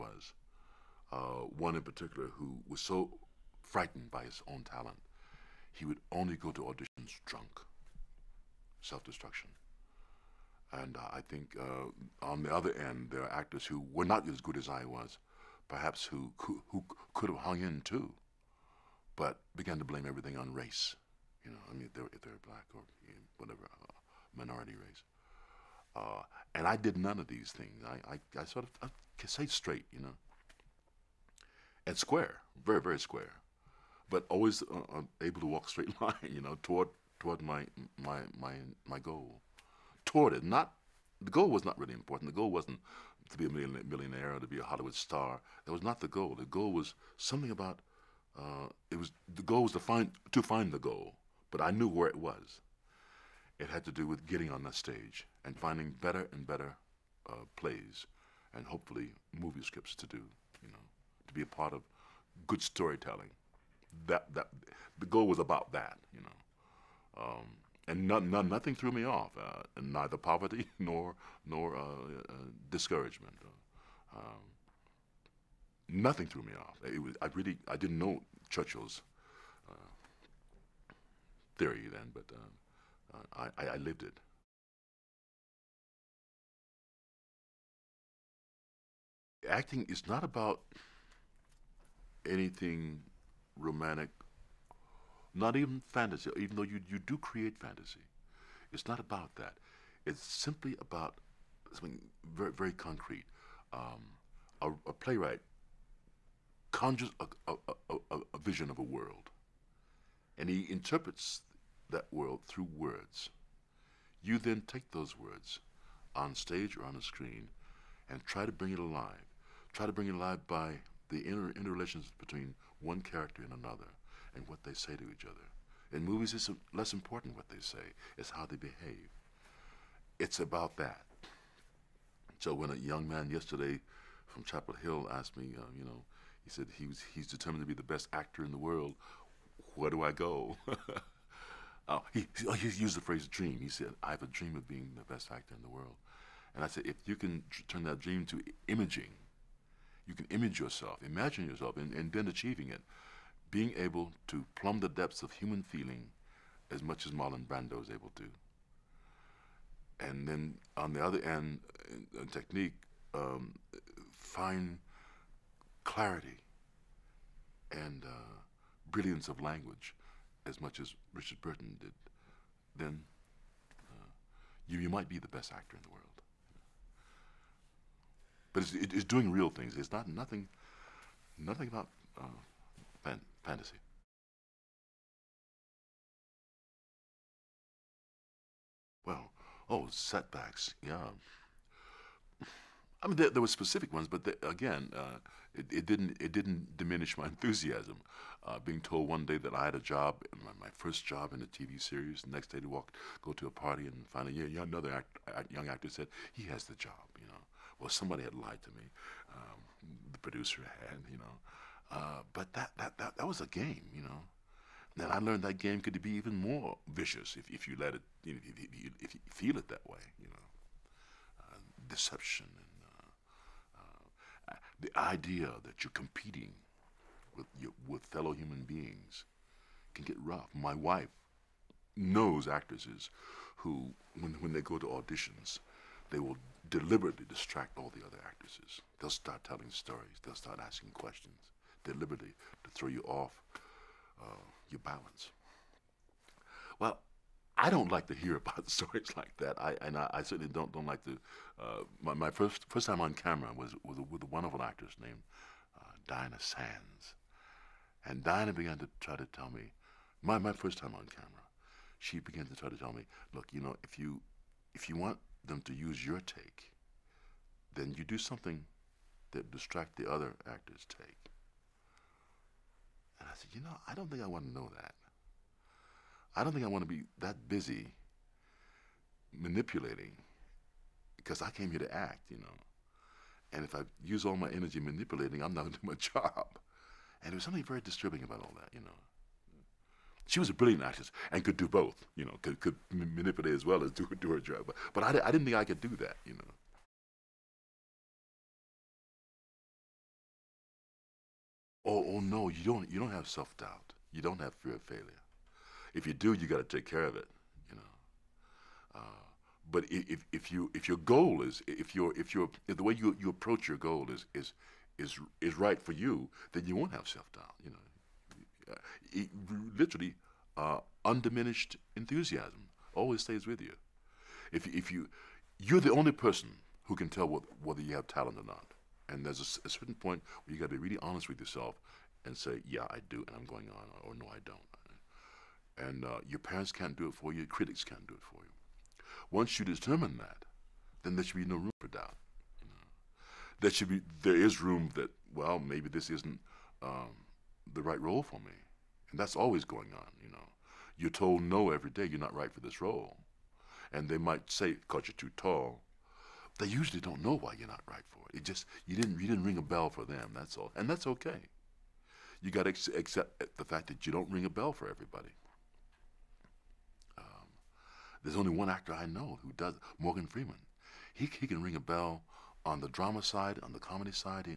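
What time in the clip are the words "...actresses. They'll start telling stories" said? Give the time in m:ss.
3:58.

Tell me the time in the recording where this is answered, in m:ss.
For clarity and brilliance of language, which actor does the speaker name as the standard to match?
2:51.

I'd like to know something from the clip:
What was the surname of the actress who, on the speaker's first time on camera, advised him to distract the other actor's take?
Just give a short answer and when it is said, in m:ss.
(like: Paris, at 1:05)
Sands, at 4:16.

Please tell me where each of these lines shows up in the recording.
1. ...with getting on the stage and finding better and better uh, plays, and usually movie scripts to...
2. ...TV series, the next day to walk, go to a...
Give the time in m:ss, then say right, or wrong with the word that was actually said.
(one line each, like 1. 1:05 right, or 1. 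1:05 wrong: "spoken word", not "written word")
1. 0:54 wrong: "hopefully", not "usually"
2. 3:21 right.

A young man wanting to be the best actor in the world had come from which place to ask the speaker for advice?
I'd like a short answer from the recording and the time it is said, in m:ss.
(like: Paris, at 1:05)
Chapel Hill, at 2:14.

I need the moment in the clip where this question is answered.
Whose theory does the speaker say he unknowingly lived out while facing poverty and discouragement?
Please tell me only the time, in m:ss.
1:18.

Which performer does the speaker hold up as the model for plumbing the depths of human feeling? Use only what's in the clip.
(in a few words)
Marlon Brando.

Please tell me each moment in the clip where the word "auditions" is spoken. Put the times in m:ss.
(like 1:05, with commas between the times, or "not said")
0:06, 3:54.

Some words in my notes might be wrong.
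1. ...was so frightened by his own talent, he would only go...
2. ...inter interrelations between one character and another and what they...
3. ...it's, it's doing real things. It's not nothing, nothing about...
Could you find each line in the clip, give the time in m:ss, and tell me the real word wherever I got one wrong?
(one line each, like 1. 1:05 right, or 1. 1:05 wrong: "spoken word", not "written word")
1. 0:02 right
2. 2:01 right
3. 2:58 right.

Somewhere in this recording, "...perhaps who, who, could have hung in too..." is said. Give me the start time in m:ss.
0:15.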